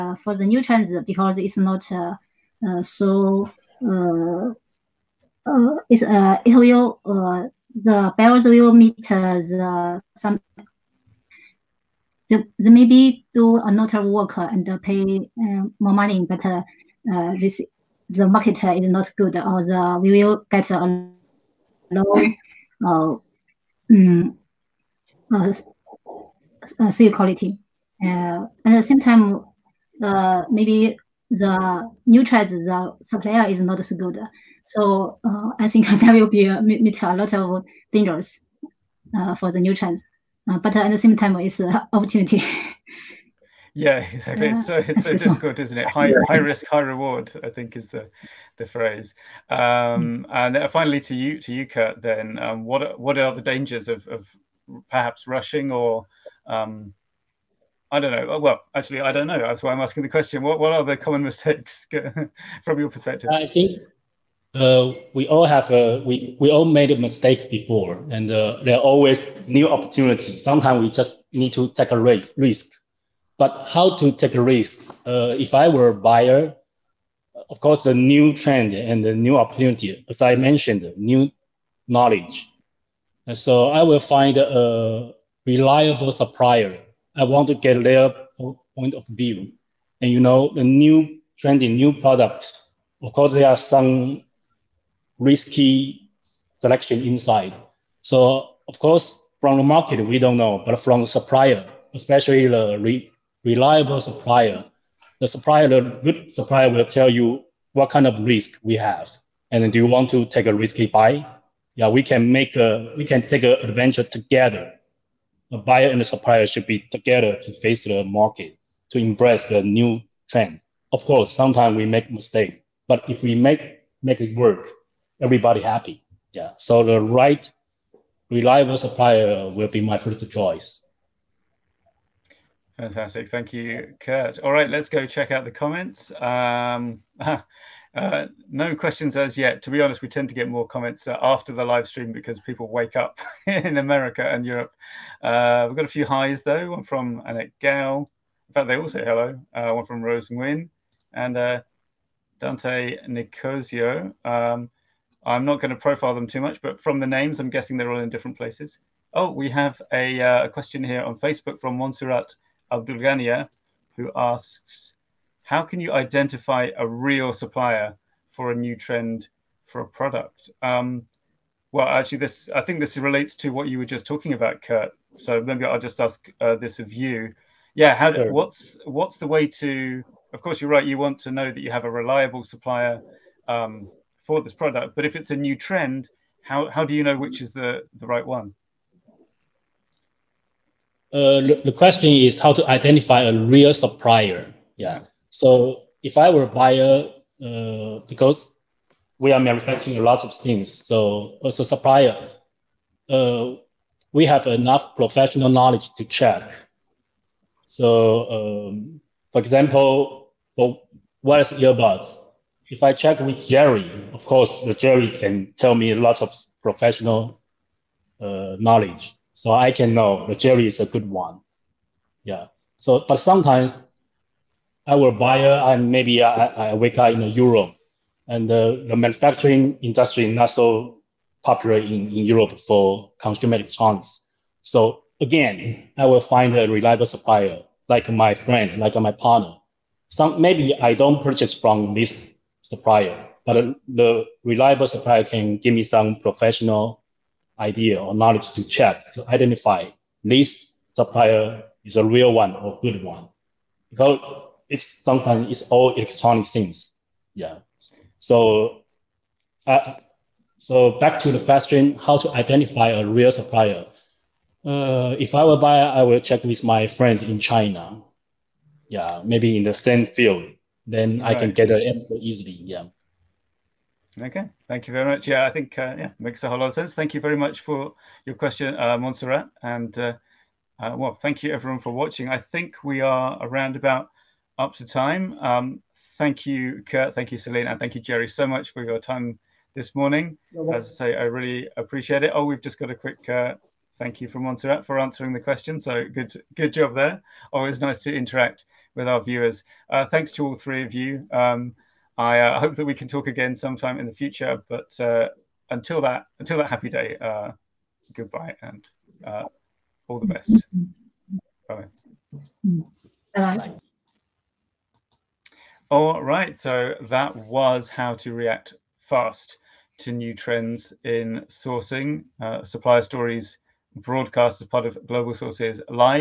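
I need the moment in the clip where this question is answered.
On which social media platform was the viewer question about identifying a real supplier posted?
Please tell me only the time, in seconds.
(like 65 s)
161 s.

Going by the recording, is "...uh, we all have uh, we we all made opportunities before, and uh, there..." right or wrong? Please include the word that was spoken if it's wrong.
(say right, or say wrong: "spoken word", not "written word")
wrong: "mistakes", not "opportunities".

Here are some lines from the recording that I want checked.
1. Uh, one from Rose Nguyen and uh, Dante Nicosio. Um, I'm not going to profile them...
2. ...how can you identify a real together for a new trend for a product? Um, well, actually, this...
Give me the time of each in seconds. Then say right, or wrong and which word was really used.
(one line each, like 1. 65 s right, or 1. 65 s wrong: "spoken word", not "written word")
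1. 149 s right
2. 165 s wrong: "supplier", not "together".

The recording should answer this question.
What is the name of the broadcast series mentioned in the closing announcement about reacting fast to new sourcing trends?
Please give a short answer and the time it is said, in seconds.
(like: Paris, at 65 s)
Supplier Stories, at 322 s.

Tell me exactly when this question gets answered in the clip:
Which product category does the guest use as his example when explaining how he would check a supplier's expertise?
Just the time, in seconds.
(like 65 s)
211 s.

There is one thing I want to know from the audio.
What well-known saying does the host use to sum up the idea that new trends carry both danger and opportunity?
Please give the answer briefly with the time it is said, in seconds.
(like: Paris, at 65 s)
High risk, high reward, at 46 s.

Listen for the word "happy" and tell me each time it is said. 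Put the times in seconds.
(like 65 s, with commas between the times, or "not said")
125 s, 306 s.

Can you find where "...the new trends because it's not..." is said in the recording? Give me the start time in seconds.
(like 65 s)
0 s.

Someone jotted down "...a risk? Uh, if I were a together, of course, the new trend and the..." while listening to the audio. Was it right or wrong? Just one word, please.
wrong.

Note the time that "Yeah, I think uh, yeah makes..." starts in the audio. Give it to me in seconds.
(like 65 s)
275 s.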